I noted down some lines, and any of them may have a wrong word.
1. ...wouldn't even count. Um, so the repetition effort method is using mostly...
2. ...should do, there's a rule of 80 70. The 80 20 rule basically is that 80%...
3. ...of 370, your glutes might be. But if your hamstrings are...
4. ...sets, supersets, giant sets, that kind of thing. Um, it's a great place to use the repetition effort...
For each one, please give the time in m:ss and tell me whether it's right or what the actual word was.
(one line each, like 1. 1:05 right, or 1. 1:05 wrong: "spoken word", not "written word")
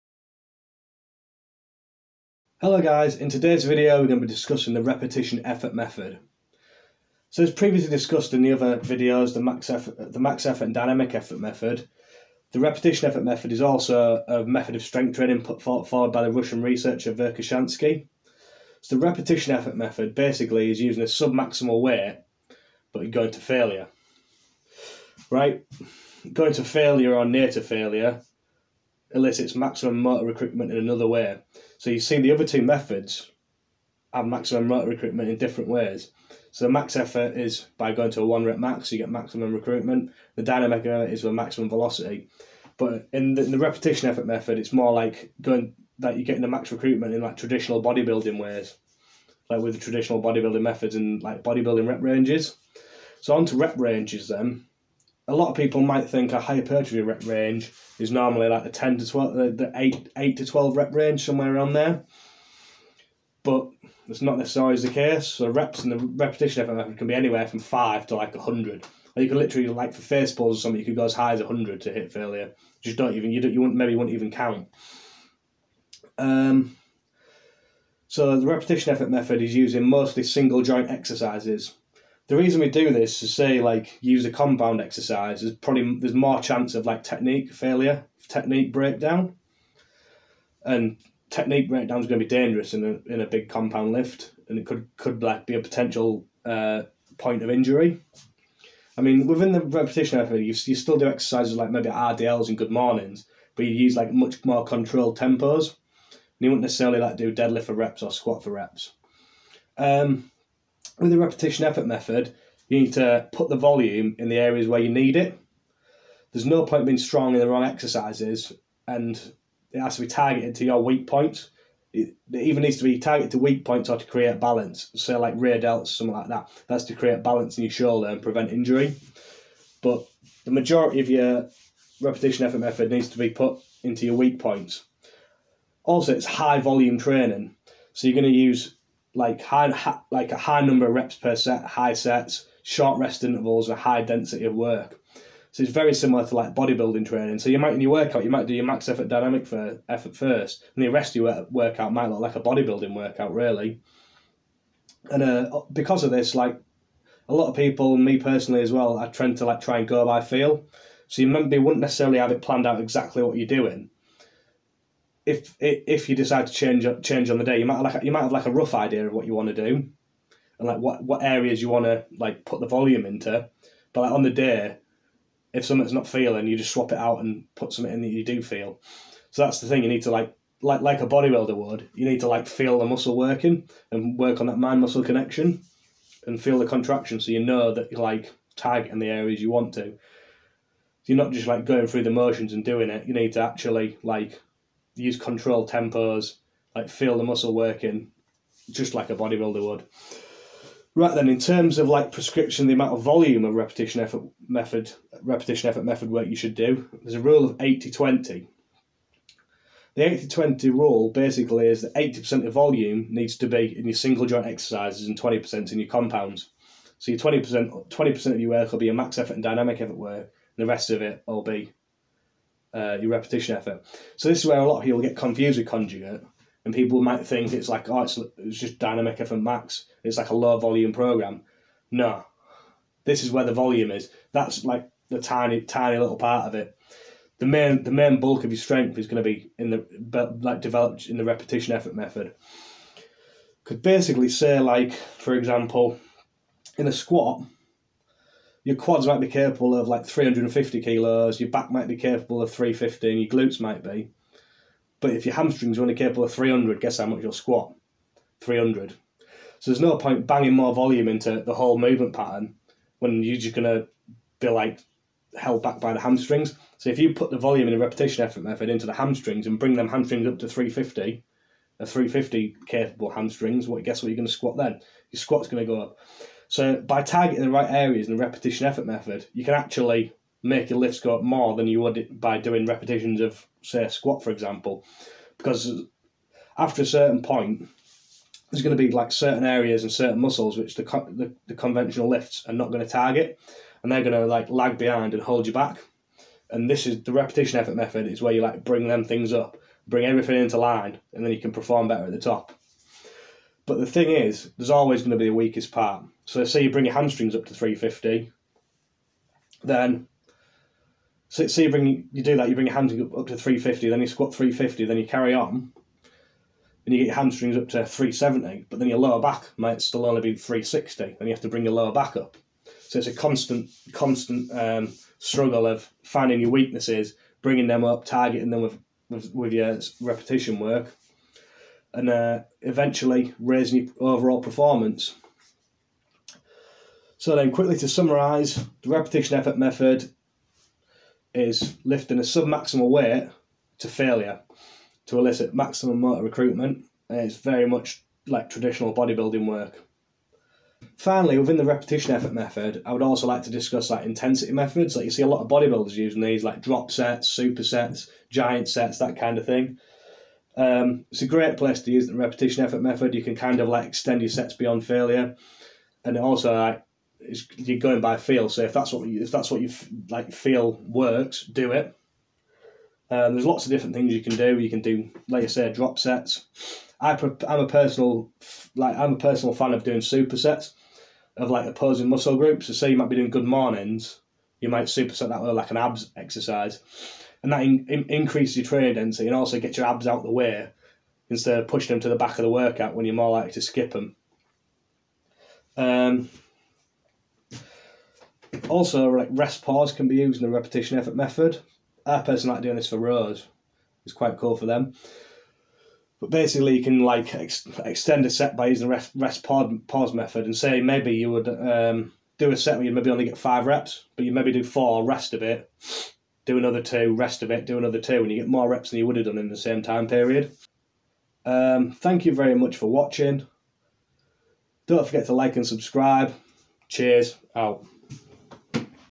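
1. 1:13 right
2. 3:26 wrong: "20", not "70"
3. 4:12 wrong: "350", not "370"
4. 5:56 right.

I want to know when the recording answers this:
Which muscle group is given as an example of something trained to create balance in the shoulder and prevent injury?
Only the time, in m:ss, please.
2:05.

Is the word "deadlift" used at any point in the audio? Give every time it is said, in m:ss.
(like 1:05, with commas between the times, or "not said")
1:47.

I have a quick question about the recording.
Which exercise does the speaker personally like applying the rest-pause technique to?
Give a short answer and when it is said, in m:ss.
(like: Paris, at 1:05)
Rows, at 6:42.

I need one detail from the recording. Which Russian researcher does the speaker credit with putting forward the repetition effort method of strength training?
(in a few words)
Verkhoshansky.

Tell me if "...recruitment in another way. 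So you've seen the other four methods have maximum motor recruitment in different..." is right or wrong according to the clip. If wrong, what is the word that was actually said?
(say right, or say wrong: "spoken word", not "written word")
wrong: "two", not "four".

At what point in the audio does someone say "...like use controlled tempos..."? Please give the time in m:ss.
3:14.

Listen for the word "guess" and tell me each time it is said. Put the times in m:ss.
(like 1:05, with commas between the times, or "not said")
4:16, 4:33.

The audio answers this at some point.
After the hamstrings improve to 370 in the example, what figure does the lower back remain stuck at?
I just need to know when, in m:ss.
5:20.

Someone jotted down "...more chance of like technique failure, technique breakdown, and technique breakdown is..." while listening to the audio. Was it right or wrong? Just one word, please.
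right.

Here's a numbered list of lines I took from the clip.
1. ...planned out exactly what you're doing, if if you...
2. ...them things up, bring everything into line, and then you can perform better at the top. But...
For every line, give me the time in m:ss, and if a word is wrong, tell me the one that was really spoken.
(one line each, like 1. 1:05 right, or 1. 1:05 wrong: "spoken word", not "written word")
1. 2:42 right
2. 4:58 right.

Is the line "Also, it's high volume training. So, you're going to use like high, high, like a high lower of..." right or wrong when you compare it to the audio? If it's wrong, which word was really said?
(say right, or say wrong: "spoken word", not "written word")
wrong: "number", not "lower".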